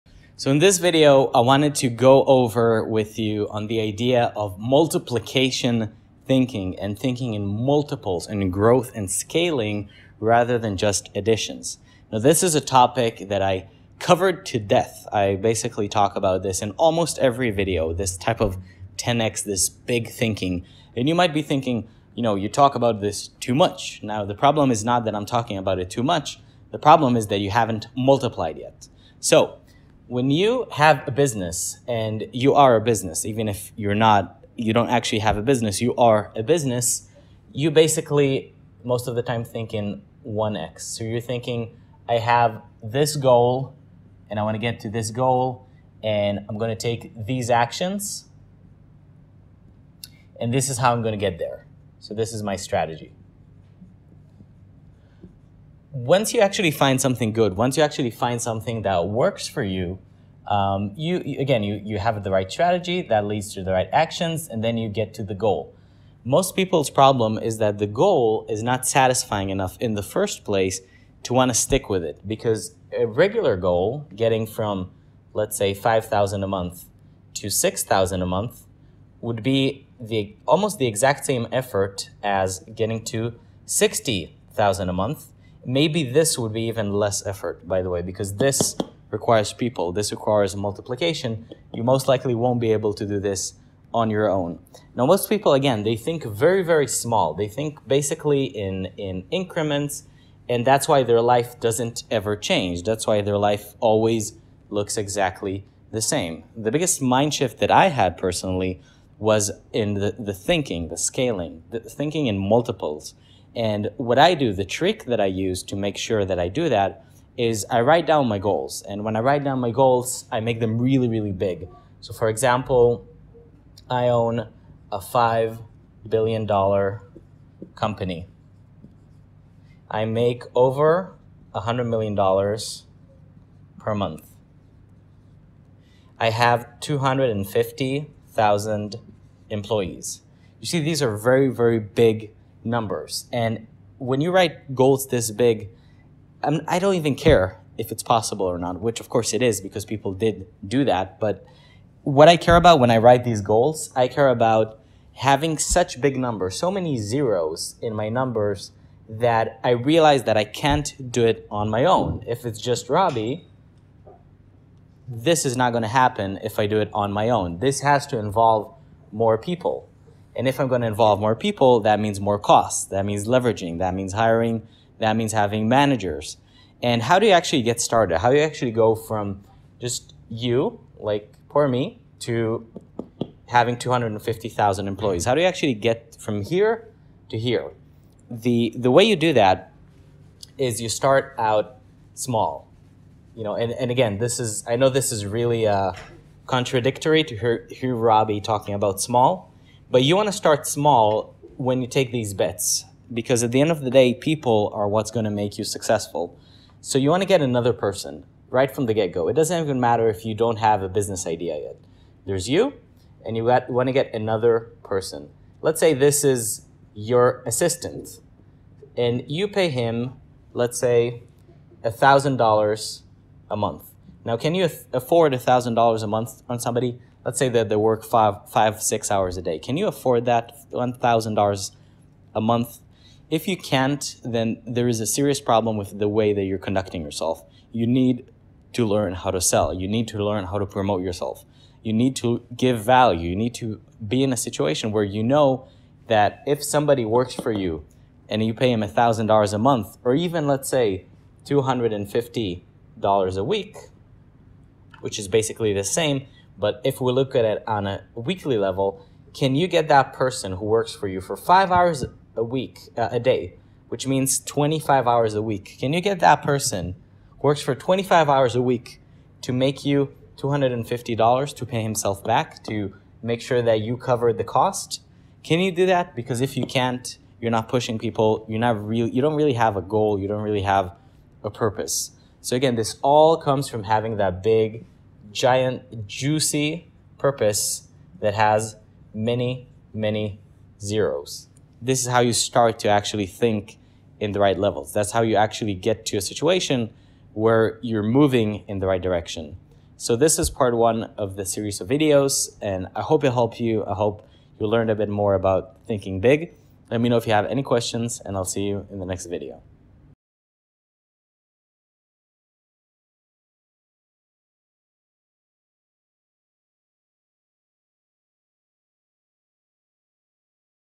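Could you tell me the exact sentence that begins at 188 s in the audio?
The, the way you do that is you start out small.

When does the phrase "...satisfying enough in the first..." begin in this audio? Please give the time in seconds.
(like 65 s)
68 s.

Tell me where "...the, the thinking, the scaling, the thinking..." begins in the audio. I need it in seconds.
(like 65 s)
109 s.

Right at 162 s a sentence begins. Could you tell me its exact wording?
If it's just Robby, this is not going to happen if I do it on my own.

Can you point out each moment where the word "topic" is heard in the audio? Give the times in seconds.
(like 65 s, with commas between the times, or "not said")
12 s.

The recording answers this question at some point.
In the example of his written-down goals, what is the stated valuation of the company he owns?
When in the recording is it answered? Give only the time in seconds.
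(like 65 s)
124 s.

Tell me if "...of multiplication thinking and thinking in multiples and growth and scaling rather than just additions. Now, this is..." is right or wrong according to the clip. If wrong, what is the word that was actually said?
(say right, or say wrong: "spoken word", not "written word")
right.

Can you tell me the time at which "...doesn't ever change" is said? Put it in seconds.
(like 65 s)
101 s.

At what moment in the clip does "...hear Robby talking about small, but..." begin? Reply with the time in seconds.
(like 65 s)
197 s.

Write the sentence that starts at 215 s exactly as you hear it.
Let's say this is your assistant, and you pay him, let's say, $1,000 a month.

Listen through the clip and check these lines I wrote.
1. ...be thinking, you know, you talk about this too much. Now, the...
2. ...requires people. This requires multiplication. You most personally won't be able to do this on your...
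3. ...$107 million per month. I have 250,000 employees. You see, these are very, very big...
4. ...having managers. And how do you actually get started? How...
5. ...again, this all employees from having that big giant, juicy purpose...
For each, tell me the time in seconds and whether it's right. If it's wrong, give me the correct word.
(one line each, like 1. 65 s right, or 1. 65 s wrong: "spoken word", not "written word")
1. 21 s right
2. 89 s wrong: "likely", not "personally"
3. 131 s wrong: "100", not "107"
4. 175 s right
5. 282 s wrong: "comes", not "employees".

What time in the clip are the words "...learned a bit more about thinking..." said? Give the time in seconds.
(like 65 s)
304 s.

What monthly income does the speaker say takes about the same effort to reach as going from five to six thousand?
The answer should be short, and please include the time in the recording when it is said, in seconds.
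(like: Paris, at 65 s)
60,000 a month, at 83 s.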